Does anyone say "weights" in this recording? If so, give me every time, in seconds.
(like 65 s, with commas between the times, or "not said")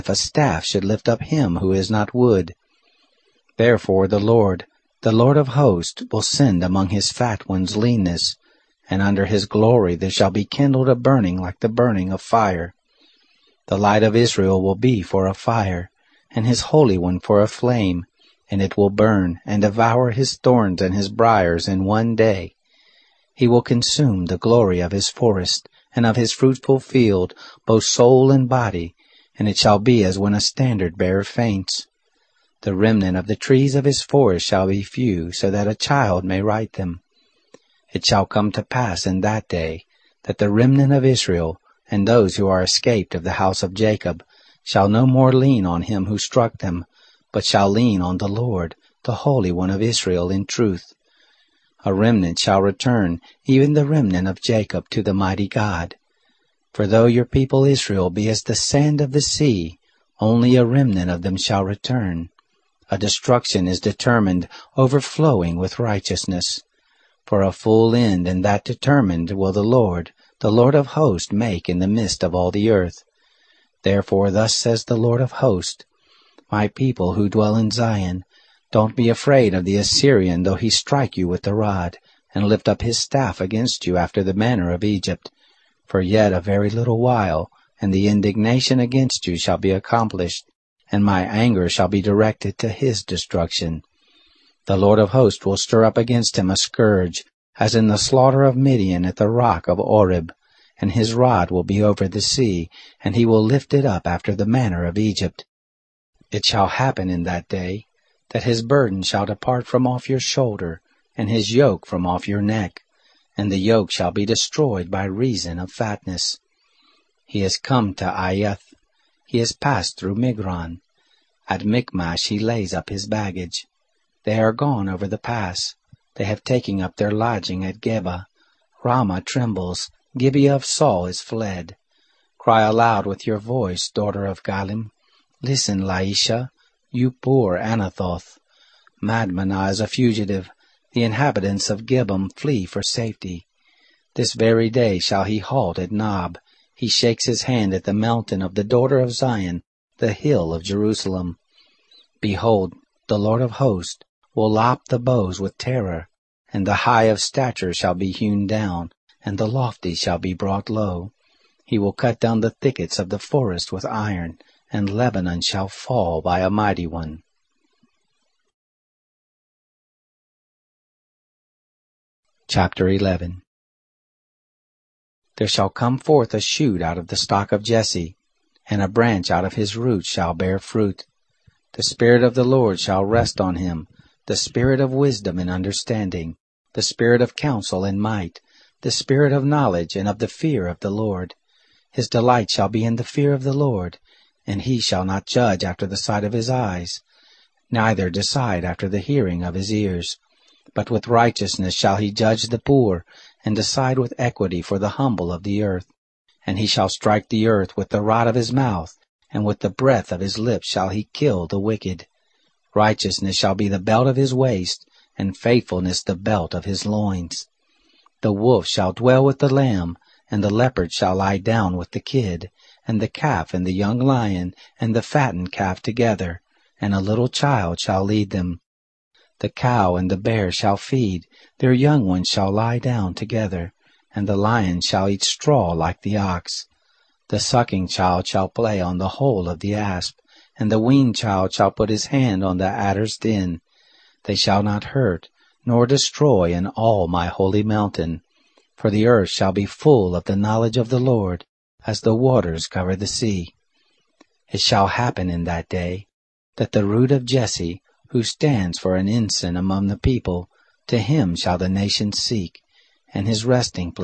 not said.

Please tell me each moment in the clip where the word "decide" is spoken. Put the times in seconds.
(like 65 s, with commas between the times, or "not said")
198 s, 203 s.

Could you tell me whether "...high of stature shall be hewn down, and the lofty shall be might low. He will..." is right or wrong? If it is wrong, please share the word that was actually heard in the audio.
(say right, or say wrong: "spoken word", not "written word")
wrong: "brought", not "might".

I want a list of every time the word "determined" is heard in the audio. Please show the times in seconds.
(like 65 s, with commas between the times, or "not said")
63 s, 68 s.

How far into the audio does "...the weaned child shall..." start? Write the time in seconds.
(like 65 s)
240 s.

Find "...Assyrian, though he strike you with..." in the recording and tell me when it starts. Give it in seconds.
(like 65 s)
79 s.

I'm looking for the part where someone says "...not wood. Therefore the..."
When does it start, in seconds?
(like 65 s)
1 s.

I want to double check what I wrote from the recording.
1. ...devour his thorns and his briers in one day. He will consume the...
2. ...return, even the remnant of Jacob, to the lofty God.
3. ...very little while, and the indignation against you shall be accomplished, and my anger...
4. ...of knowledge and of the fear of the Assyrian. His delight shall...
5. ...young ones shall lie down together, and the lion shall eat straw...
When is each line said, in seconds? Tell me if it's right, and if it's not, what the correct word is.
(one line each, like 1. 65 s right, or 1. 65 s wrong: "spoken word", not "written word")
1. 19 s right
2. 52 s wrong: "mighty", not "lofty"
3. 86 s right
4. 189 s wrong: "Lord", not "Assyrian"
5. 231 s right.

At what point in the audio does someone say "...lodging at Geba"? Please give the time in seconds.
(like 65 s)
127 s.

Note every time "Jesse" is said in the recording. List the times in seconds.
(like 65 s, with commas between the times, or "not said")
177 s, 257 s.